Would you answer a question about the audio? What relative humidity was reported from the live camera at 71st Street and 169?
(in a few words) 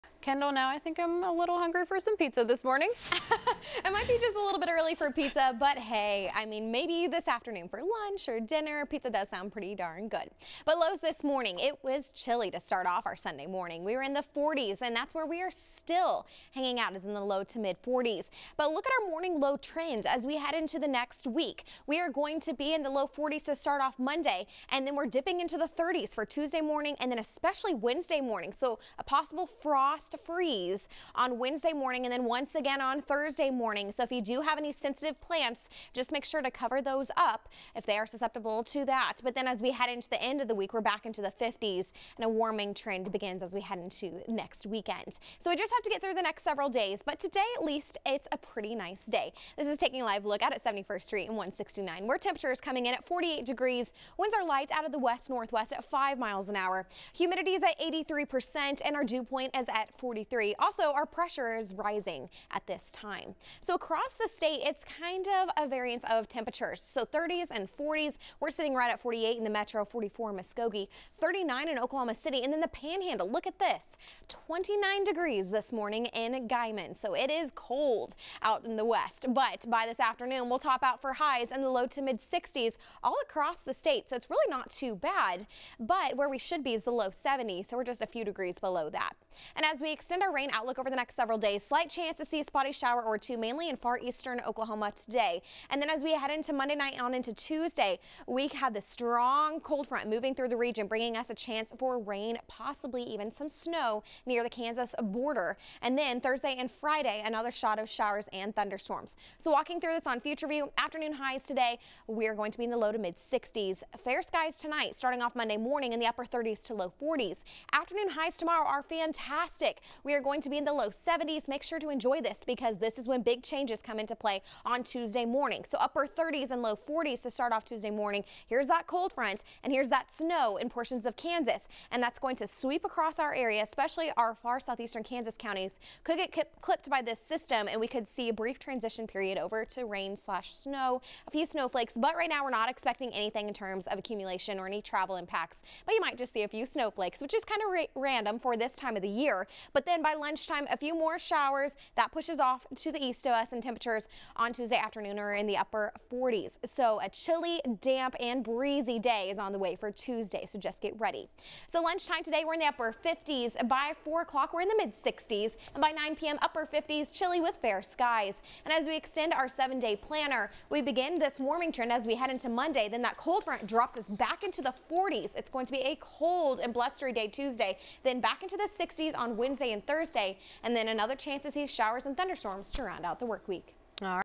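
83%.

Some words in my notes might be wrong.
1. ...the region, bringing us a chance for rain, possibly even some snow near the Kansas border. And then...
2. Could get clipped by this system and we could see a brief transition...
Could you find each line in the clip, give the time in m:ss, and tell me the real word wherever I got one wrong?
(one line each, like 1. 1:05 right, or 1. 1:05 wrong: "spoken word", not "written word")
1. 1:40 right
2. 2:16 right.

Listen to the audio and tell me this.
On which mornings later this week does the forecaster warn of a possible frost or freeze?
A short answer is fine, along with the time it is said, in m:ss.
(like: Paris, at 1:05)
Wednesday and Thursday, at 0:31.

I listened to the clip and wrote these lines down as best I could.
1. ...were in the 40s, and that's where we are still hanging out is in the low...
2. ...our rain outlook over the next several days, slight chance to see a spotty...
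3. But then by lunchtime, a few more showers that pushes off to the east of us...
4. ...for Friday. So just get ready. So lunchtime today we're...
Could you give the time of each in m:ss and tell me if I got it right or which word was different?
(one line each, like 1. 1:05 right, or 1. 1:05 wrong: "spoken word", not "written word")
1. 0:13 right
2. 1:30 right
3. 2:29 right
4. 2:39 wrong: "Tuesday", not "Friday".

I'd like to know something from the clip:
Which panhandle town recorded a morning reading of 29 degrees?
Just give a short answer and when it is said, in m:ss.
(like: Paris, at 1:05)
Guymon, at 1:16.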